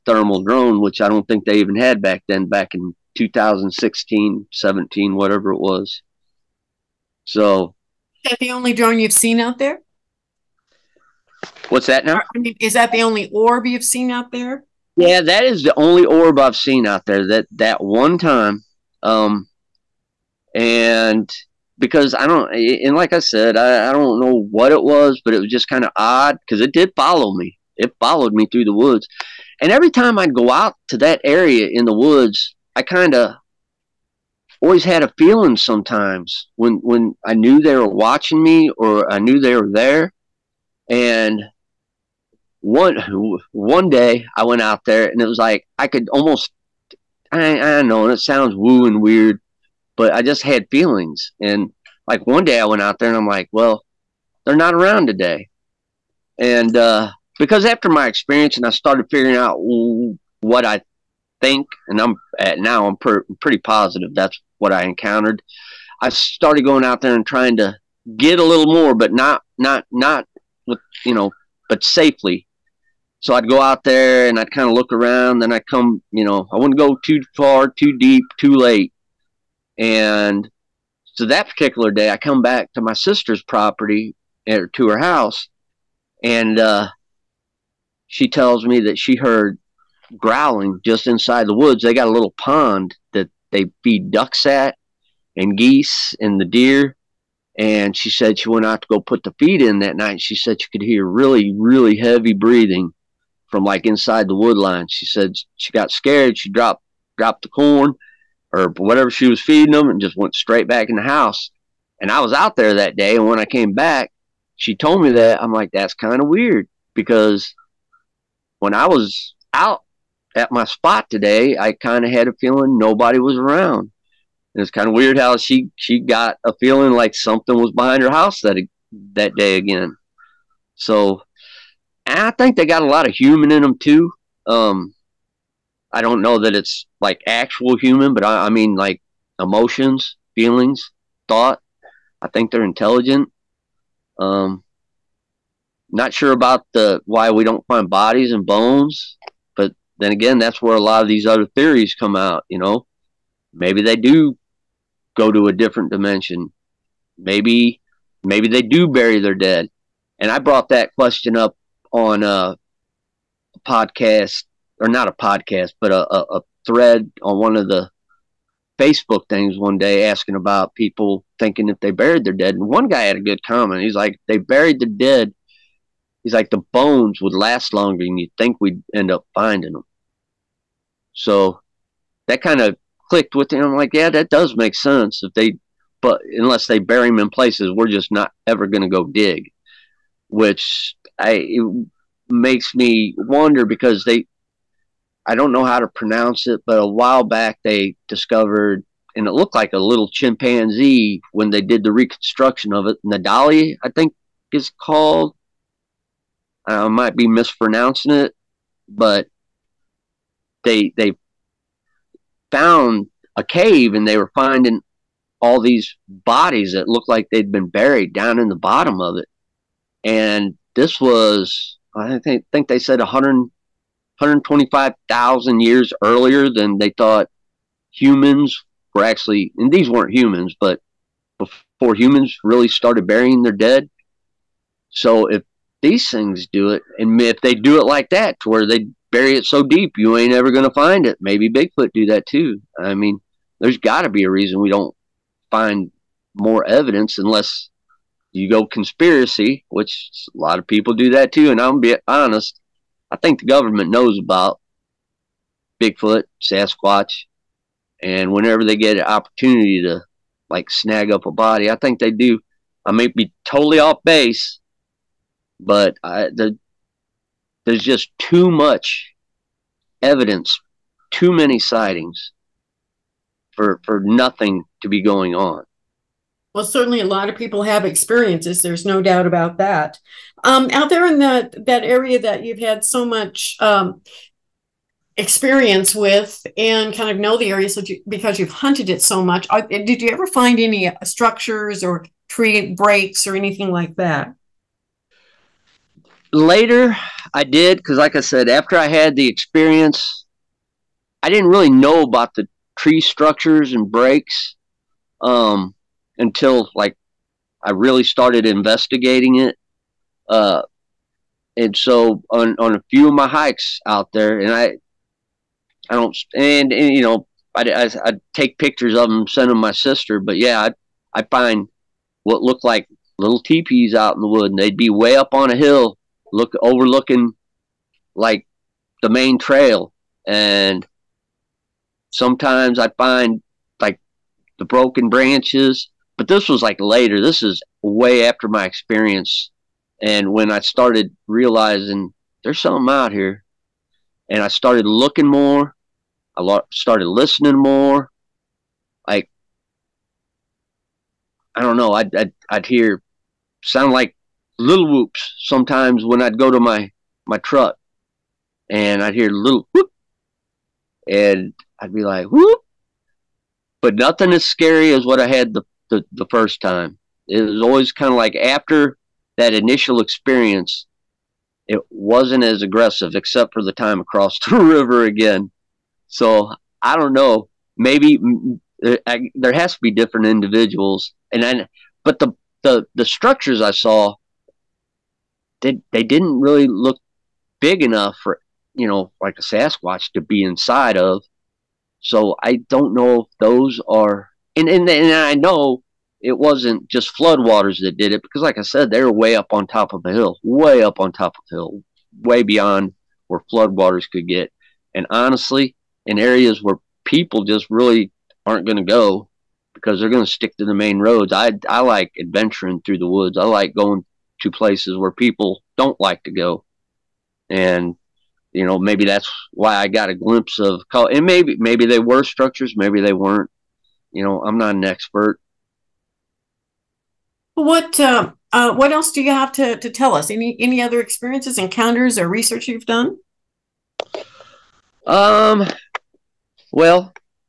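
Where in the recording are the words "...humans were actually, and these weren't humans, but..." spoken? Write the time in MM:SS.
03:47.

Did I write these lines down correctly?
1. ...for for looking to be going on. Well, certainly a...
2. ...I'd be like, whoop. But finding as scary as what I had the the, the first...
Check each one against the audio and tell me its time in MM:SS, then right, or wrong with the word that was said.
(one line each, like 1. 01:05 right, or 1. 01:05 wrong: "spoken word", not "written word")
1. 04:33 wrong: "nothing", not "looking"
2. 06:01 wrong: "nothing", not "finding".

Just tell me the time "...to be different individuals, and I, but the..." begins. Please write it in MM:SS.
06:19.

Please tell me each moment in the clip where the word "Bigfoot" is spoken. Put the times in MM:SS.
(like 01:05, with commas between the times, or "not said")
04:01, 04:15.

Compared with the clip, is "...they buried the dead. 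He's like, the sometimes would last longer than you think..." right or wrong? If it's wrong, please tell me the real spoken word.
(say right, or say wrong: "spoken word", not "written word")
wrong: "bones", not "sometimes".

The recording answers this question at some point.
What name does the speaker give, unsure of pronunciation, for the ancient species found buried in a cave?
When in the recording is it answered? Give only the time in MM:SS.
03:23.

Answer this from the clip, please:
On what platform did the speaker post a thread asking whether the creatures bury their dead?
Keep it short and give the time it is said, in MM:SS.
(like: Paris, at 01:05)
Facebook, at 02:48.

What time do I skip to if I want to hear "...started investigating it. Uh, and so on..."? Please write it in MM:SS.
05:08.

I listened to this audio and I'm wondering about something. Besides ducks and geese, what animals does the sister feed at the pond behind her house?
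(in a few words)
deer.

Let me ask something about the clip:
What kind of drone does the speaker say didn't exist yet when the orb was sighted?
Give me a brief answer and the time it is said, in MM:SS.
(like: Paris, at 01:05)
thermal drone, at 00:00.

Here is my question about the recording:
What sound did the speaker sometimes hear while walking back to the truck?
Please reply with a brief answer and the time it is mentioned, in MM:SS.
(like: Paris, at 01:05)
whoops, at 05:54.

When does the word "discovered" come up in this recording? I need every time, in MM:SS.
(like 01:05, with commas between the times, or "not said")
03:18.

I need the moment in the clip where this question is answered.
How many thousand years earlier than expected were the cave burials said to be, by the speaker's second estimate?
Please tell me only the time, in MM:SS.
03:44.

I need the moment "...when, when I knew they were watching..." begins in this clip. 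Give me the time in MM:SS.
00:36.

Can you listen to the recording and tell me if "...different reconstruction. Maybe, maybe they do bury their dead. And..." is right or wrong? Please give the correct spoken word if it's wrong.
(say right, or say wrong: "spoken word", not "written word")
wrong: "dimension", not "reconstruction".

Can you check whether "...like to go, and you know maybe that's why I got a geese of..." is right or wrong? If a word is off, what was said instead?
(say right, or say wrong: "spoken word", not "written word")
wrong: "glimpse", not "geese".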